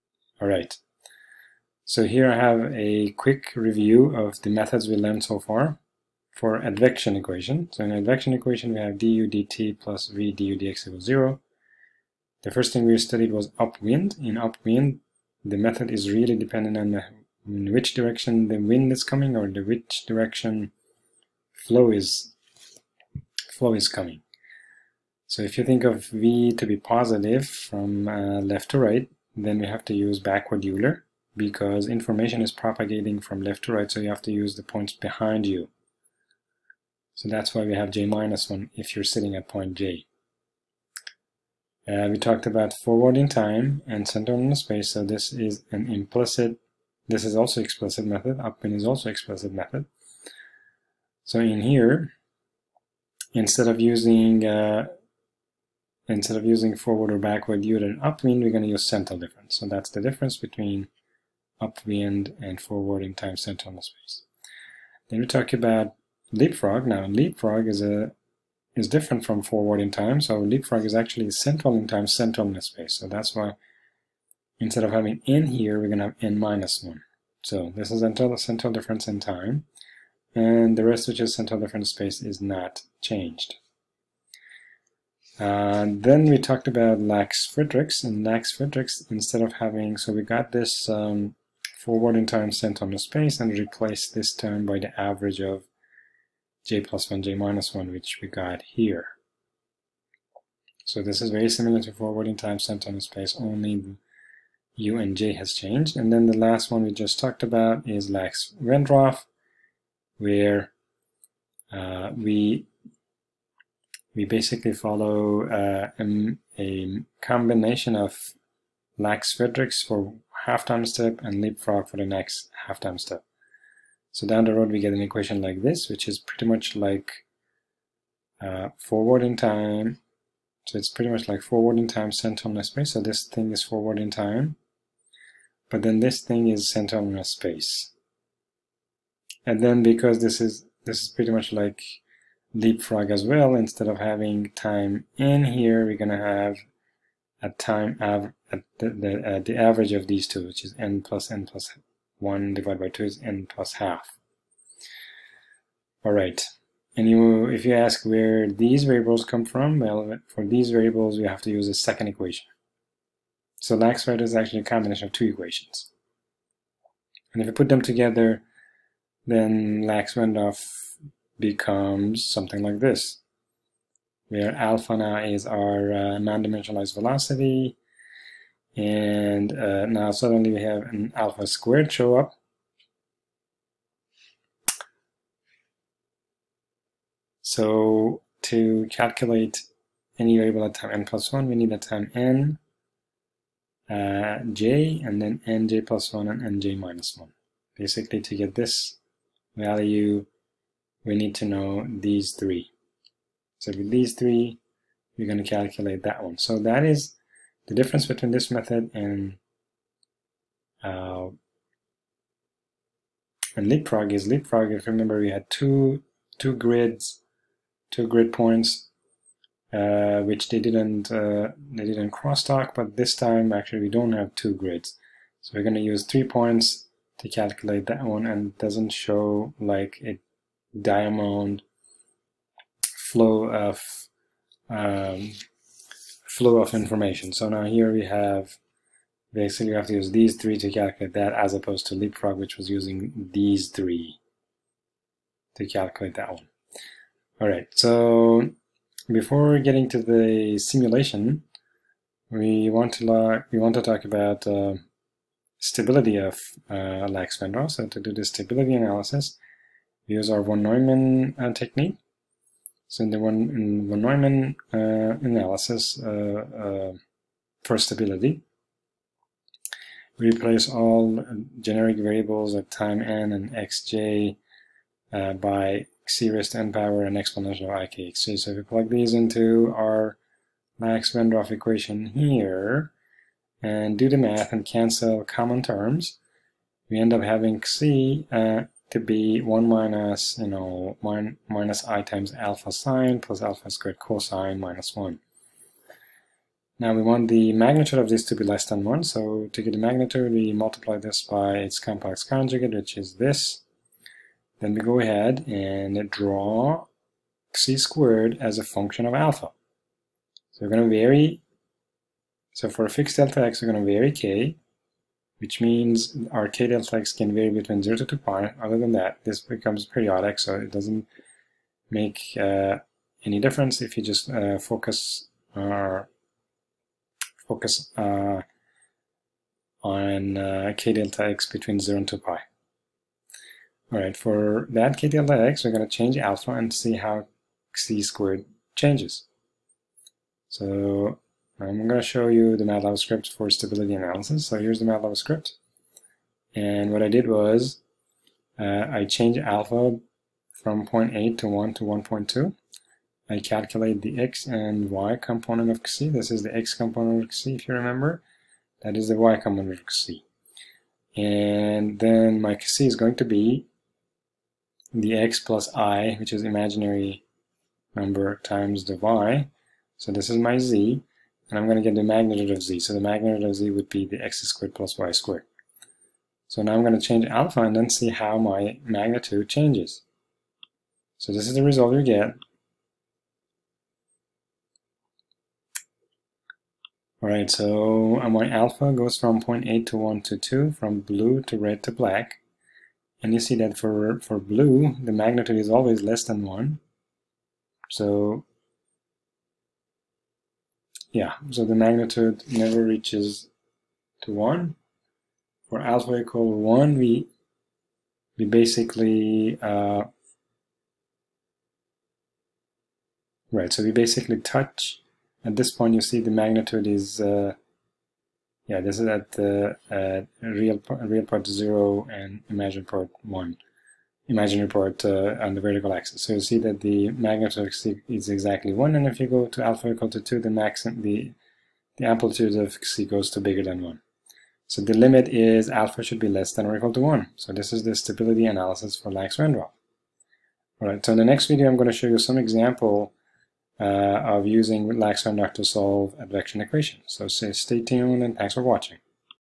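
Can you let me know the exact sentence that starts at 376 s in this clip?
So now I'm going to change alpha and then see how my magnitude changes.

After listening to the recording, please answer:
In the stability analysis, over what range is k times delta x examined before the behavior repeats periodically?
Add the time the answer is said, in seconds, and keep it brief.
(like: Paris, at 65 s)
0 to 2 pi, at 317 s.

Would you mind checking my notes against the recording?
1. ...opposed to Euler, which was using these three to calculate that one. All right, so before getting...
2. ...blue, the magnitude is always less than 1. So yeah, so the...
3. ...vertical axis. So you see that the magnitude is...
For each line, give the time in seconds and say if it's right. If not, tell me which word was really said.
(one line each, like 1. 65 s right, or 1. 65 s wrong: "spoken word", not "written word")
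1. 241 s wrong: "LeapFrog", not "Euler"
2. 394 s right
3. 425 s right.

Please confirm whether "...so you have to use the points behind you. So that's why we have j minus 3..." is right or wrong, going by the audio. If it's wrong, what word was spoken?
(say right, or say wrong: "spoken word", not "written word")
wrong: "1", not "3".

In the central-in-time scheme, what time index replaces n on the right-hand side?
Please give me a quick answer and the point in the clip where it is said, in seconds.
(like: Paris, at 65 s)
n minus 1, at 76 s.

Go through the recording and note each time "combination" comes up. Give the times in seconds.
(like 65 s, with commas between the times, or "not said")
117 s, 164 s.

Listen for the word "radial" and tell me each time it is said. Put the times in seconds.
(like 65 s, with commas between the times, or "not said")
316 s.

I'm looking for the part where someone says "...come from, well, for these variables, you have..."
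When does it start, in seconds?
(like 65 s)
159 s.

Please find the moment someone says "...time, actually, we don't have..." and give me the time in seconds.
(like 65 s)
223 s.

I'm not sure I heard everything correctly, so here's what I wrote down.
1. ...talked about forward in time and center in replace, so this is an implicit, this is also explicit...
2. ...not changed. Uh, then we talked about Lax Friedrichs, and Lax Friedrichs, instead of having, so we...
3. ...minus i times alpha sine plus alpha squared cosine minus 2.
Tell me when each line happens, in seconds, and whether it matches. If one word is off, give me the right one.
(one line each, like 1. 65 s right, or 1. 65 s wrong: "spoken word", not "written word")
1. 42 s wrong: "space", not "replace"
2. 82 s right
3. 291 s wrong: "1", not "2".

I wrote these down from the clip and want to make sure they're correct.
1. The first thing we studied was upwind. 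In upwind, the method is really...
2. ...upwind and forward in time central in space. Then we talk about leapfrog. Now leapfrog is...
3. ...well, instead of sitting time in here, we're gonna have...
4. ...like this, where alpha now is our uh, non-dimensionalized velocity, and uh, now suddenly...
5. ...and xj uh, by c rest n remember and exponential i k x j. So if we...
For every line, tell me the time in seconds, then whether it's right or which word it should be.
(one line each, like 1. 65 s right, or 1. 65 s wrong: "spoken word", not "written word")
1. 12 s right
2. 61 s right
3. 143 s wrong: "having", not "sitting"
4. 172 s right
5. 273 s wrong: "power", not "remember".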